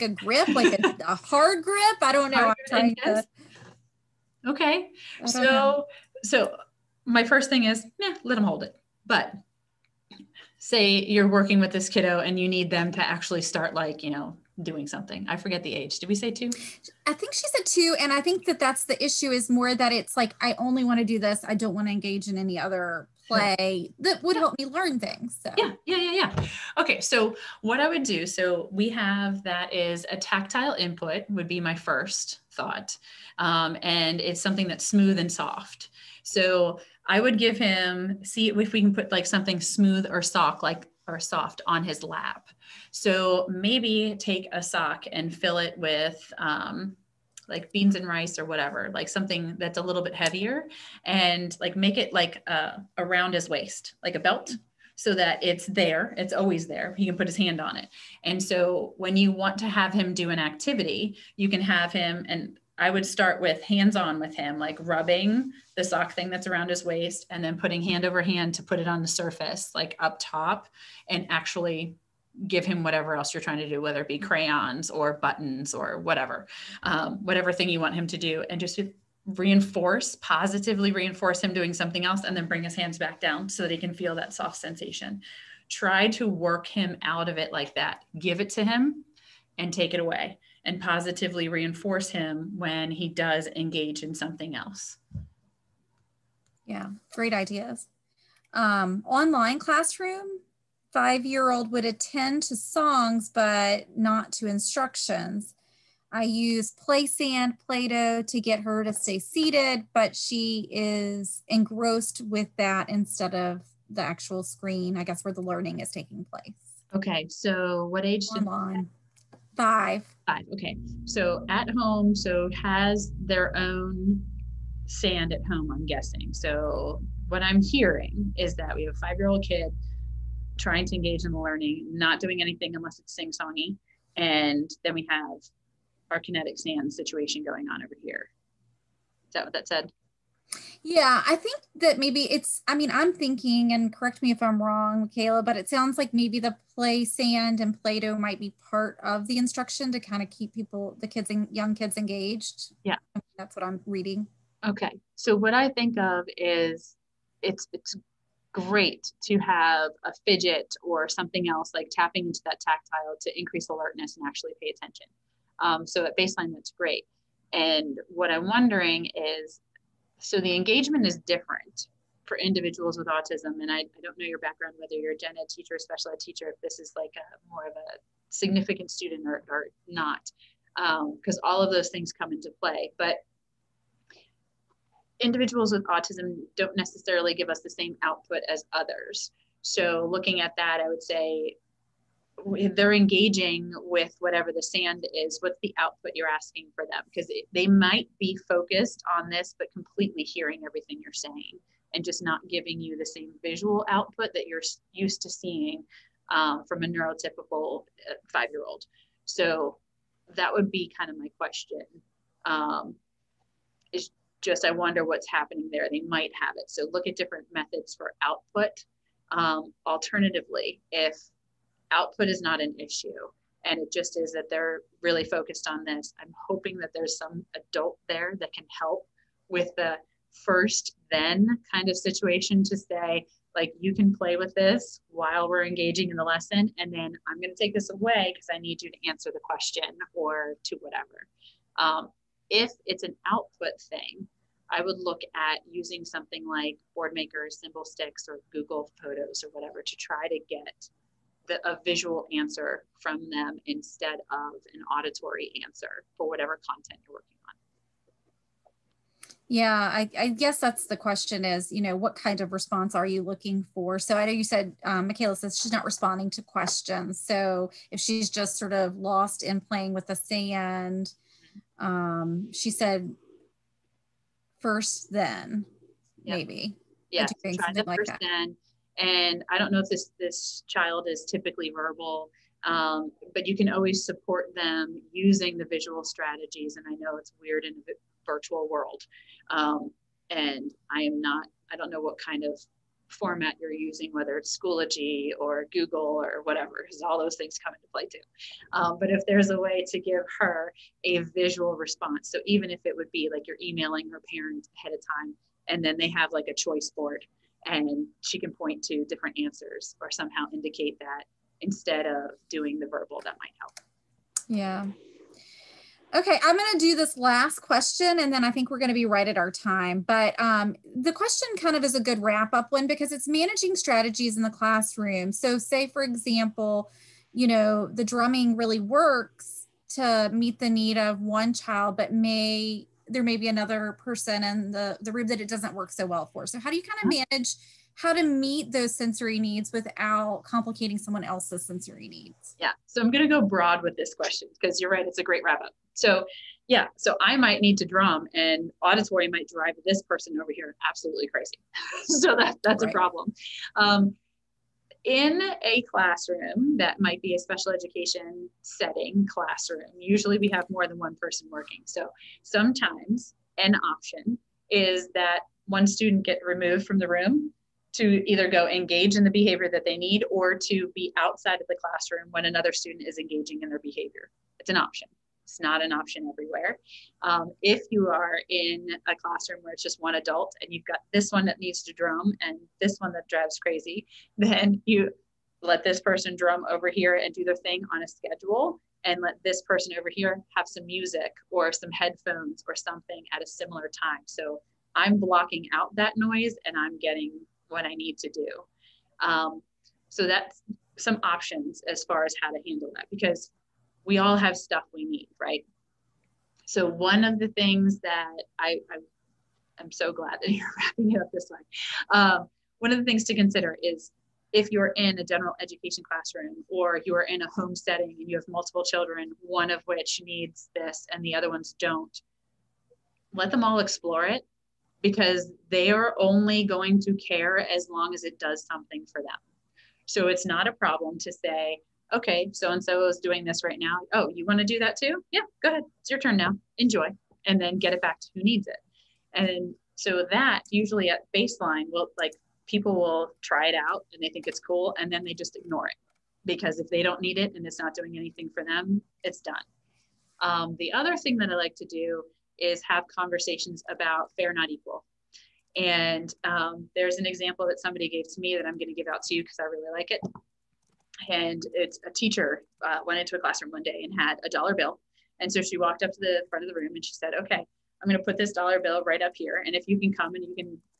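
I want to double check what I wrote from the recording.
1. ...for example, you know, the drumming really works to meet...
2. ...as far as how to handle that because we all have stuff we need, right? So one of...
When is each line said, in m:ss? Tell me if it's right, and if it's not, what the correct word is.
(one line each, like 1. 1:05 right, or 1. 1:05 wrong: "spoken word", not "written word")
1. 5:25 right
2. 6:41 right.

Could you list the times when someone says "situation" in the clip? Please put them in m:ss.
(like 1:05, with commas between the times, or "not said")
2:16, 3:51.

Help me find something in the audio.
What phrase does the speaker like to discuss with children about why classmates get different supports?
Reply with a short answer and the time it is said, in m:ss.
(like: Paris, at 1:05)
fair, not equal, at 7:34.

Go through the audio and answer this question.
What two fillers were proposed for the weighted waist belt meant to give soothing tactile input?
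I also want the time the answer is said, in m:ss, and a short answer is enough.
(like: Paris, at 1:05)
beans and rice, at 0:47.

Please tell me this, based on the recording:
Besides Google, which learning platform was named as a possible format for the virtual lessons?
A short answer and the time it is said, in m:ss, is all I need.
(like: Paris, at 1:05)
Schoology, at 4:54.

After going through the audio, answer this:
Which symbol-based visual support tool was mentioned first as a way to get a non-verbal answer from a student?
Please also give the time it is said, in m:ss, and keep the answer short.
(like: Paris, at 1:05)
board makers, at 4:06.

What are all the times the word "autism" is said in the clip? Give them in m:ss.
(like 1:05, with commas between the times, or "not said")
2:53, 3:05.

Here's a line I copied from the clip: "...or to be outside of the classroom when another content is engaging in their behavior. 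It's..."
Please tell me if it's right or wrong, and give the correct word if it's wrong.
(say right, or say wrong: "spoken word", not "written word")
wrong: "student", not "content".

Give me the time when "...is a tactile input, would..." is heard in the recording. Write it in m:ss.
0:29.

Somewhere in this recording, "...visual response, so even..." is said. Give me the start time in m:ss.
5:01.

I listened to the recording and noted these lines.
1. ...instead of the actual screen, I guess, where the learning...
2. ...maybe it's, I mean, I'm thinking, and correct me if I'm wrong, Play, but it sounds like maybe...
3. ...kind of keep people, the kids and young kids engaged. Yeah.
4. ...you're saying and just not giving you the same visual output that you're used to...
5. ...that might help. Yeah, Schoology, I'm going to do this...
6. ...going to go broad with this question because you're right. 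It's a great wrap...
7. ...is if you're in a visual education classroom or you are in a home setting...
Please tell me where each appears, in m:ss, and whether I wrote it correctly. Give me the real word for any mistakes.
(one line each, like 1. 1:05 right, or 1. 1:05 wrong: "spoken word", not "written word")
1. 1:52 right
2. 2:21 wrong: "Michaela", not "Play"
3. 2:29 right
4. 3:21 right
5. 5:13 wrong: "Okay", not "Schoology"
6. 5:43 right
7. 6:53 wrong: "general", not "visual".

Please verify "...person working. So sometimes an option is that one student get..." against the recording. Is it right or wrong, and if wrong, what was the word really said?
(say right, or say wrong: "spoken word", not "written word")
right.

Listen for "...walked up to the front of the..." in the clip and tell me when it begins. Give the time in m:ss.
7:45.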